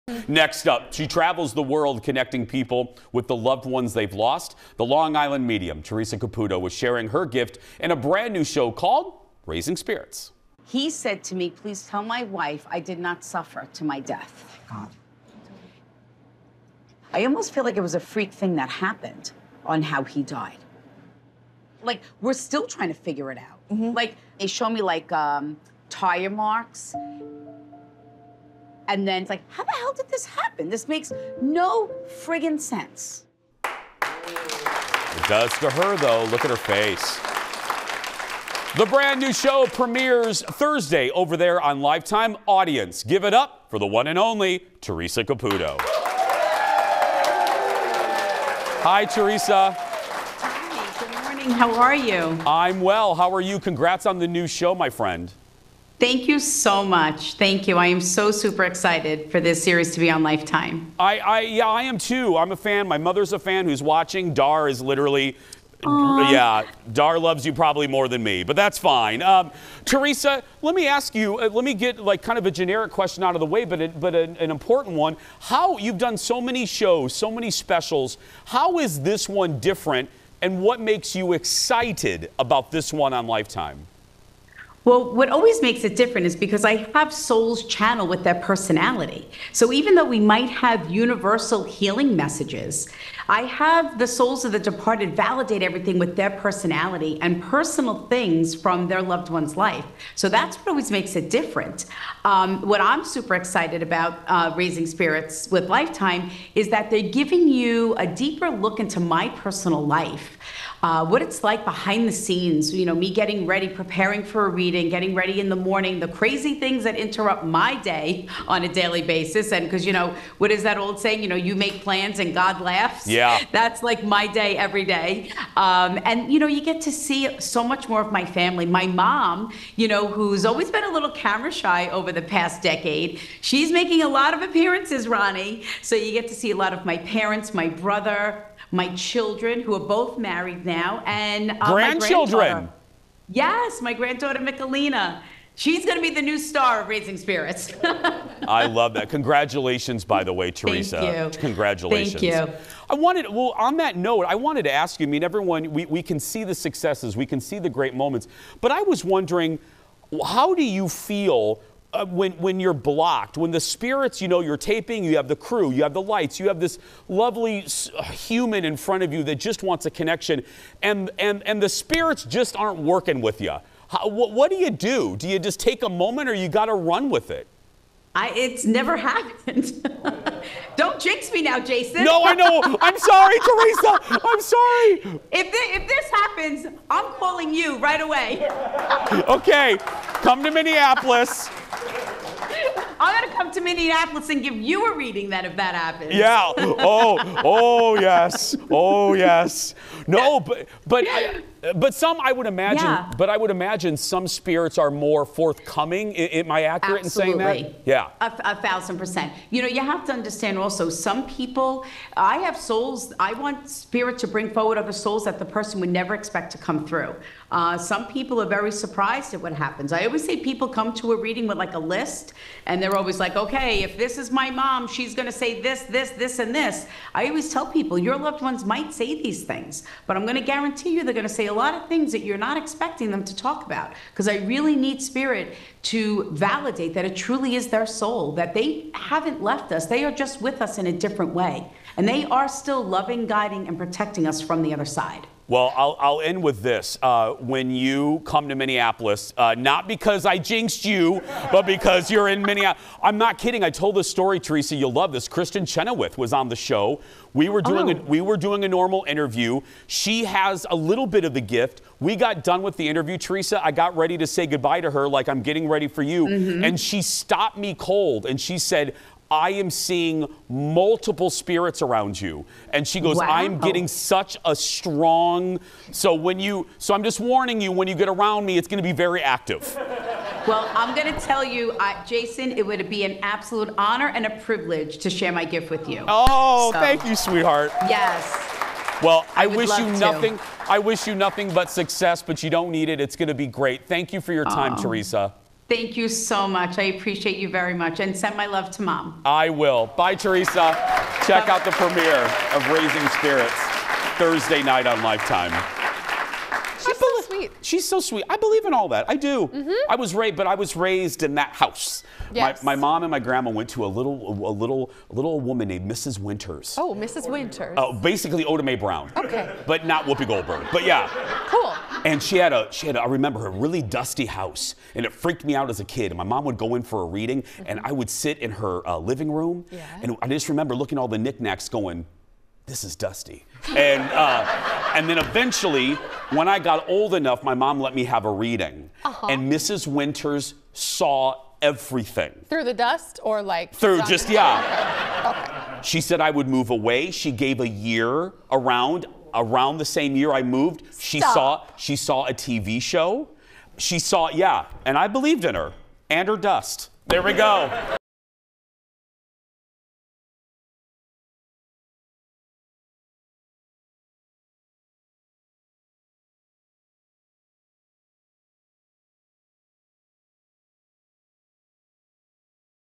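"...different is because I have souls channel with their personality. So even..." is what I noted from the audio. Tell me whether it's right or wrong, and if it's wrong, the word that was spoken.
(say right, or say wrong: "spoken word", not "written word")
right.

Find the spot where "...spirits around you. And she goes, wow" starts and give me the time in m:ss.
4:31.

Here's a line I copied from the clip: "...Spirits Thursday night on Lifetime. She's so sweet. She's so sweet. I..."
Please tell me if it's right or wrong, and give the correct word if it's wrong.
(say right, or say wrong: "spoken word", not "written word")
right.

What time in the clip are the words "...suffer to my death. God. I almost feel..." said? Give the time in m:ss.
0:13.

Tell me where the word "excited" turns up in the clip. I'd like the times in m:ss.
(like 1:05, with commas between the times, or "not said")
0:58, 1:21, 1:43.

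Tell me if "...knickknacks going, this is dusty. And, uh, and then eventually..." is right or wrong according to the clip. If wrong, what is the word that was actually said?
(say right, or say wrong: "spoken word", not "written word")
right.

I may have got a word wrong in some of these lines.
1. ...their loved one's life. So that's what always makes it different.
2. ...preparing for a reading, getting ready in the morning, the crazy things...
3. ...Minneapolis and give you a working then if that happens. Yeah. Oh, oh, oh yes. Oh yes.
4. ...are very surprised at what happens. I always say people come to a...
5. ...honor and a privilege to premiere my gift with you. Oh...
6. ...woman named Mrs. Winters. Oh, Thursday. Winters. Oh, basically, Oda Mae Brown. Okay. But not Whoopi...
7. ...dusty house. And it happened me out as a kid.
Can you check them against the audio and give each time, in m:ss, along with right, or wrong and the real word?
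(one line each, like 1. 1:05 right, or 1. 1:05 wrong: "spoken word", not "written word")
1. 1:38 right
2. 1:53 right
3. 3:13 wrong: "reading", not "working"
4. 3:38 right
5. 4:43 wrong: "share", not "premiere"
6. 5:15 wrong: "Mrs", not "Thursday"
7. 5:23 wrong: "freaked", not "happened".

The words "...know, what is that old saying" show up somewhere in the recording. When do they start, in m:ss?
1:59.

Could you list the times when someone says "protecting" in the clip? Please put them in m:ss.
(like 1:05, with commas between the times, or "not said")
4:03.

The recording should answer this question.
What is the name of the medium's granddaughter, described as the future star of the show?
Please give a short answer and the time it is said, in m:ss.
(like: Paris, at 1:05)
Michelina, at 2:24.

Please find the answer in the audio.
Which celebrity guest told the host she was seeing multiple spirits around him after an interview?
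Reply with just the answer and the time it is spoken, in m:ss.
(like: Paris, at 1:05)
Kristin Chenoweth, at 4:15.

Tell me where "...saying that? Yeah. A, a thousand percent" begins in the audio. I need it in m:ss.
3:27.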